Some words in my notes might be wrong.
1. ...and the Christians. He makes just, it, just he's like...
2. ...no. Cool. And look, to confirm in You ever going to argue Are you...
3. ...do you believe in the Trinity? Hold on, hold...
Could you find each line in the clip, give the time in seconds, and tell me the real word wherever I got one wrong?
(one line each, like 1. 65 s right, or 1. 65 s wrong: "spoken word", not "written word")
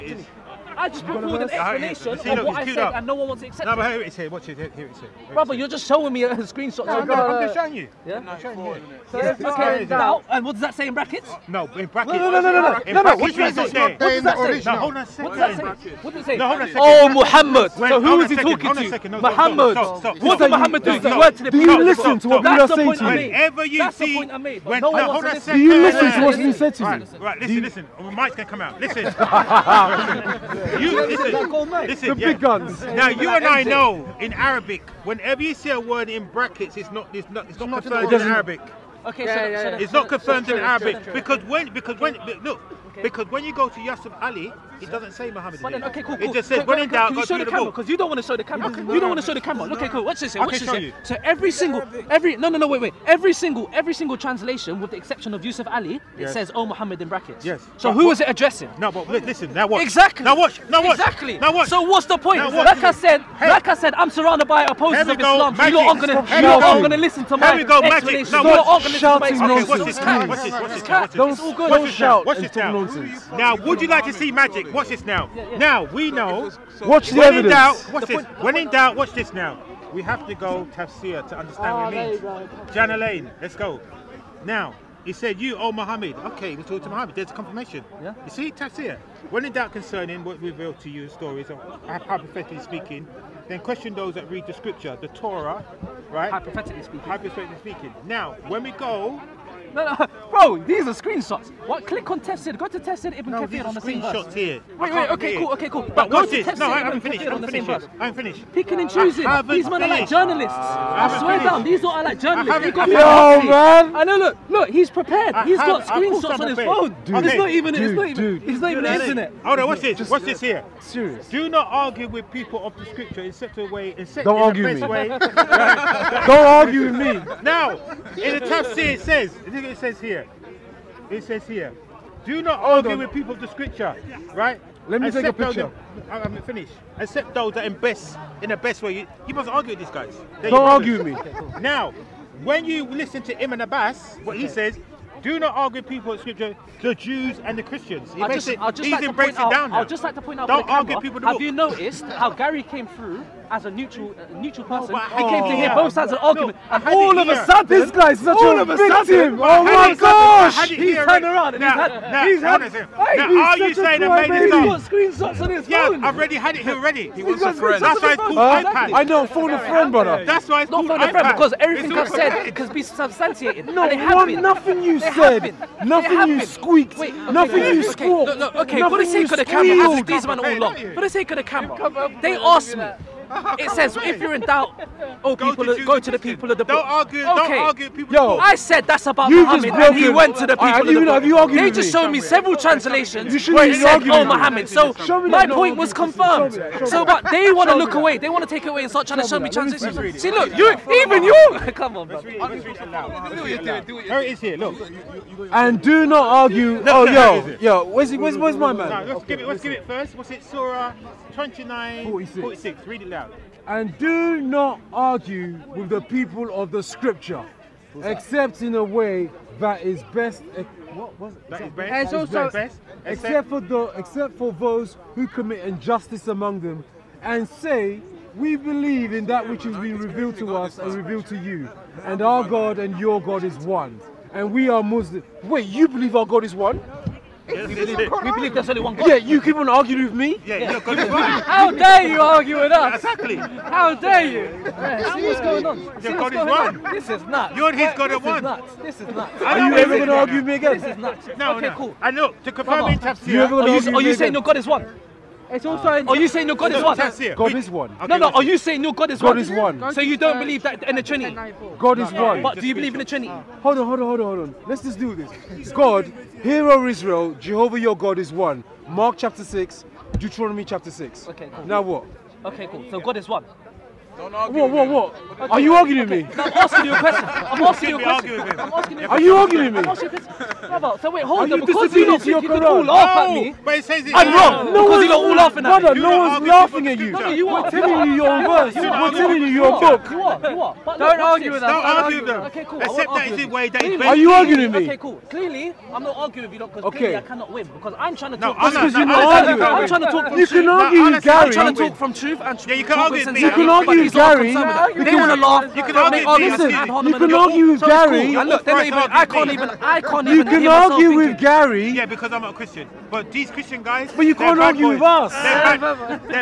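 1. 147 s right
2. 251 s right
3. 262 s right.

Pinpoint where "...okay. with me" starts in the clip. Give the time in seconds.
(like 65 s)
276 s.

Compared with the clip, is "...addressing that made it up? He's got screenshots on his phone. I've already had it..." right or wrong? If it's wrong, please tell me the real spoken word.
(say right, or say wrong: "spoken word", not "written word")
wrong: "saying", not "addressing".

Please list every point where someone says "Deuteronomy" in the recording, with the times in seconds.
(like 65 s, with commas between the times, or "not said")
270 s.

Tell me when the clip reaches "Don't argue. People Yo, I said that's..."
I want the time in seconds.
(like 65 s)
187 s.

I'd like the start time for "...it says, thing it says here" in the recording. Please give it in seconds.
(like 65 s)
128 s.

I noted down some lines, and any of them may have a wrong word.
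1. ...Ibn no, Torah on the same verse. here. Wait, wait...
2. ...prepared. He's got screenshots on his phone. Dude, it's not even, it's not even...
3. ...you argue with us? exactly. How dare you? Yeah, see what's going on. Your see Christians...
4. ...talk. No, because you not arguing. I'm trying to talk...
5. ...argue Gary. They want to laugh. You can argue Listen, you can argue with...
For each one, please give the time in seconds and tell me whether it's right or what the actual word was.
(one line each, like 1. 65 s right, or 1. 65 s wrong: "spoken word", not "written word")
1. 103 s wrong: "Kathir", not "Torah"
2. 114 s right
3. 242 s wrong: "God", not "Christians"
4. 298 s right
5. 304 s right.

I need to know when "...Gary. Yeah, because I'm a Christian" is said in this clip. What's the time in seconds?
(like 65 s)
311 s.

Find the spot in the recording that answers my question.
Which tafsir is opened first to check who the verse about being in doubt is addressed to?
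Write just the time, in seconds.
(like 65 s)
82 s.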